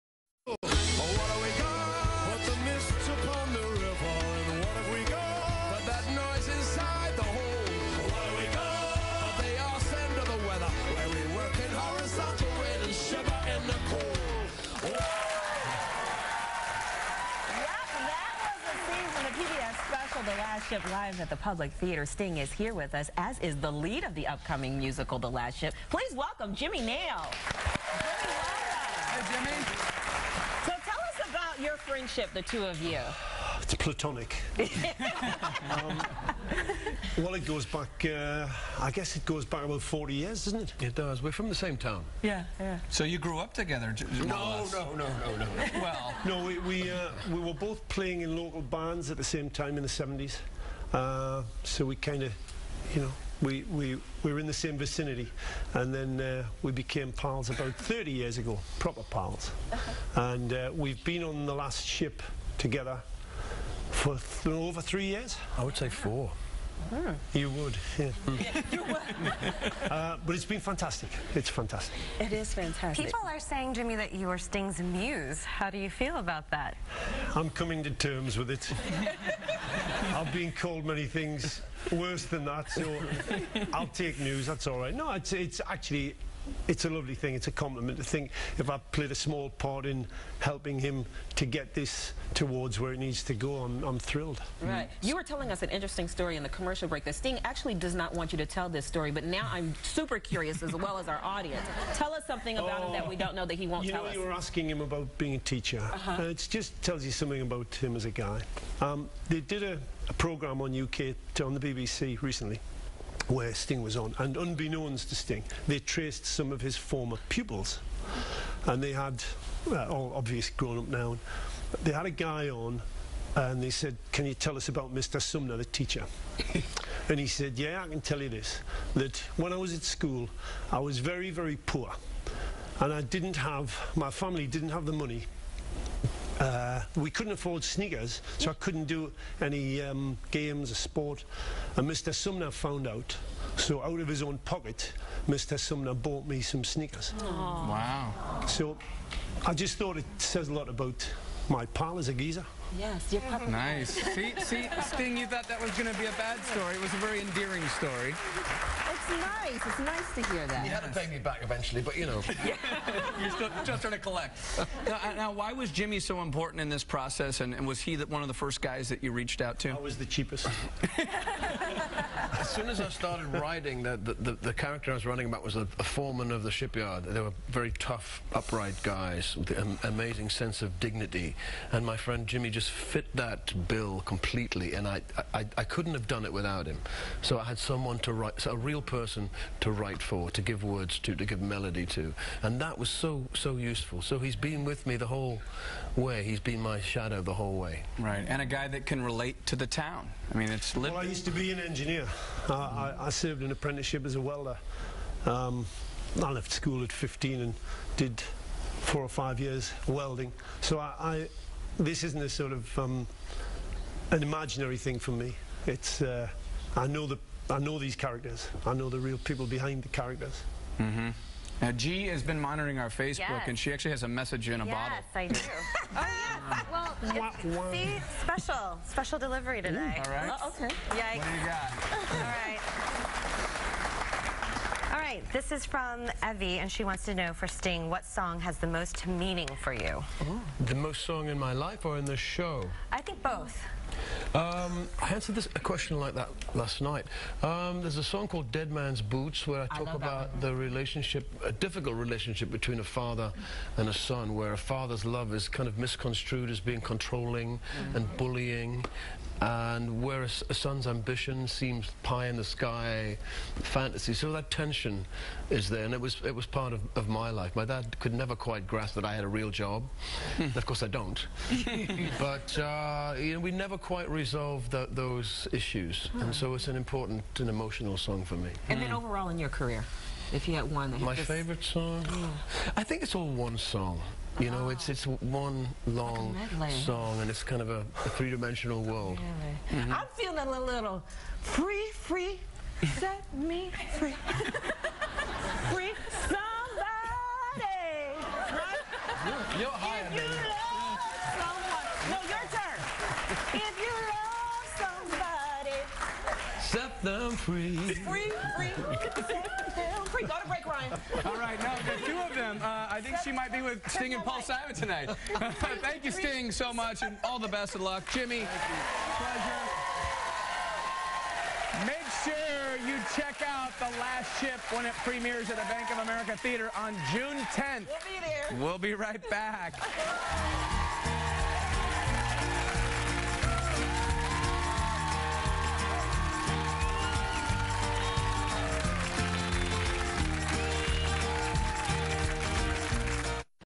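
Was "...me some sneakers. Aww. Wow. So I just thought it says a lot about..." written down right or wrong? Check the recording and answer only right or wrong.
right.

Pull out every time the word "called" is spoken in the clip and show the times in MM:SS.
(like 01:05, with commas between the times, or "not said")
01:20, 04:08.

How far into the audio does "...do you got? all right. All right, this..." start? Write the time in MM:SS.
03:51.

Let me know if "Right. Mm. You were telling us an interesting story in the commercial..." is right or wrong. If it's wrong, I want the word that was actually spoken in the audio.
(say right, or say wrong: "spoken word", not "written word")
right.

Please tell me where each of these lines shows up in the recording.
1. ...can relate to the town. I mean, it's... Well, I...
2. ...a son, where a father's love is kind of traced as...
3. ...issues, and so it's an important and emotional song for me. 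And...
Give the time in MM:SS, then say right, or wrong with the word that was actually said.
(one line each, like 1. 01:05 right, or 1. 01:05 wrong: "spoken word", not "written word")
1. 03:18 right
2. 04:13 wrong: "misconstrued", not "traced"
3. 04:35 right.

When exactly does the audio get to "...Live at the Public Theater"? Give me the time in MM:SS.
00:20.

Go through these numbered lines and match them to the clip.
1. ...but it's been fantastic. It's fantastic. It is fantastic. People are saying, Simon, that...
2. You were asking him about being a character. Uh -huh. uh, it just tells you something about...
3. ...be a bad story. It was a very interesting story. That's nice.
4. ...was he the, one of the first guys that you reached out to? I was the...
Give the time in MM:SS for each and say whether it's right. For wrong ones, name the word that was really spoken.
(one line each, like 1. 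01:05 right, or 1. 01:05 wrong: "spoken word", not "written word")
1. 01:10 wrong: "Jimmy", not "Simon"
2. 01:44 wrong: "teacher", not "character"
3. 02:35 wrong: "endearing", not "interesting"
4. 02:47 right.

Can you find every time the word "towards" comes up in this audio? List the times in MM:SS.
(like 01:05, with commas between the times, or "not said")
01:32.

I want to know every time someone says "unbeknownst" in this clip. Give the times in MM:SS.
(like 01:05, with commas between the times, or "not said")
01:54.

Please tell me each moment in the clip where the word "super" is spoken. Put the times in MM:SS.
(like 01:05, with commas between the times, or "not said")
01:39.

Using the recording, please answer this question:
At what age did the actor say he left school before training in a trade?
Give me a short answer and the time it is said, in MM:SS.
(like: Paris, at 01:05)
15, at 03:26.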